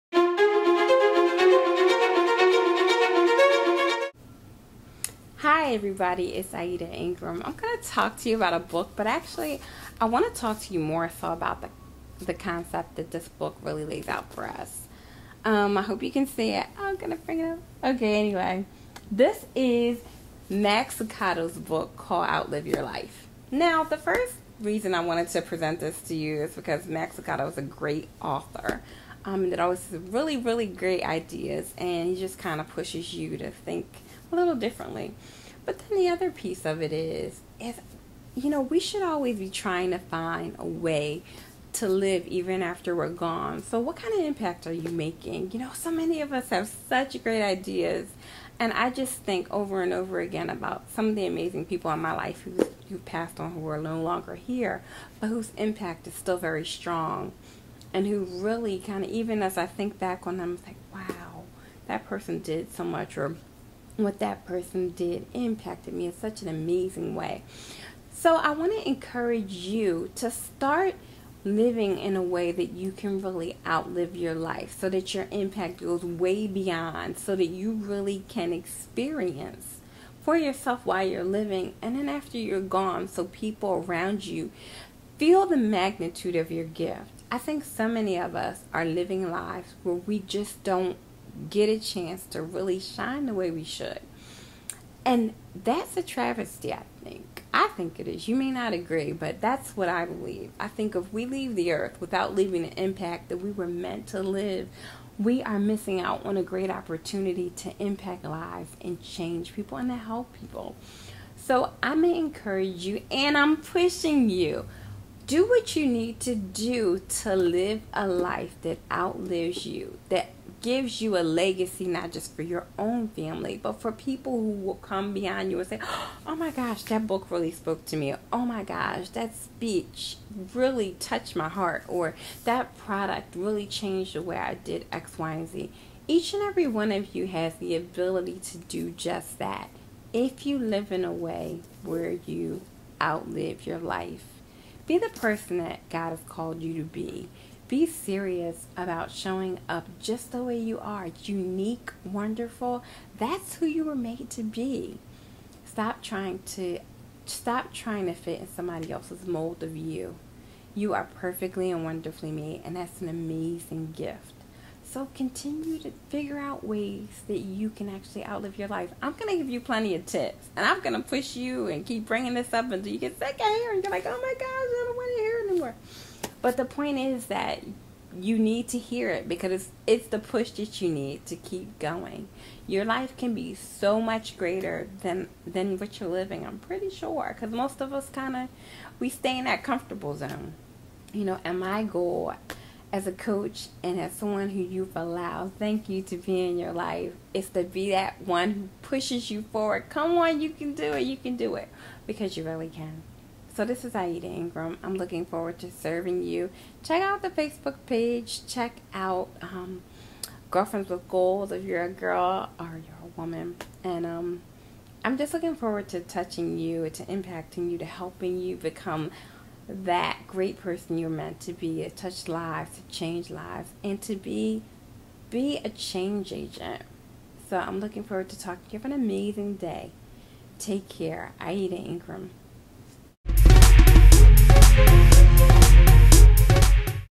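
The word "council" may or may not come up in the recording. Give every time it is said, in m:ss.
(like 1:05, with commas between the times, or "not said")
not said.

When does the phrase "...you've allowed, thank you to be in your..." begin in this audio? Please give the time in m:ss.
3:14.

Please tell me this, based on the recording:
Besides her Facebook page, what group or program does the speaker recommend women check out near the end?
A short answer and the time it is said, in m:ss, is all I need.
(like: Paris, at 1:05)
Girlfriends with Gold, at 3:30.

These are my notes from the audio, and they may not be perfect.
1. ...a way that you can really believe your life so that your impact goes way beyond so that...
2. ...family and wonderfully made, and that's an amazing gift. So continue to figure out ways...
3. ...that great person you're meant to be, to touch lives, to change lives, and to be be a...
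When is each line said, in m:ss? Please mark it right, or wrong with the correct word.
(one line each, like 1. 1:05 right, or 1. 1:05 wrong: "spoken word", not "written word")
1. 1:12 wrong: "outlive", not "believe"
2. 2:41 wrong: "perfectly", not "family"
3. 3:39 right.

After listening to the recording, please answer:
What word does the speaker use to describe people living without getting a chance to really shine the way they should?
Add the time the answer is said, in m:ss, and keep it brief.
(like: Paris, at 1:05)
travesty, at 1:36.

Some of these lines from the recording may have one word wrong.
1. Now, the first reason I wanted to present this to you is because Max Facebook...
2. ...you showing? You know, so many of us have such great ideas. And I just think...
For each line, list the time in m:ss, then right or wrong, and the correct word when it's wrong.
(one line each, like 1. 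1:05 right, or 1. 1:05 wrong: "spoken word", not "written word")
1. 0:23 wrong: "Lucado", not "Facebook"
2. 0:44 wrong: "making", not "showing".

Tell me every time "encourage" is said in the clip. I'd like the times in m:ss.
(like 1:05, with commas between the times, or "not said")
1:08, 1:52.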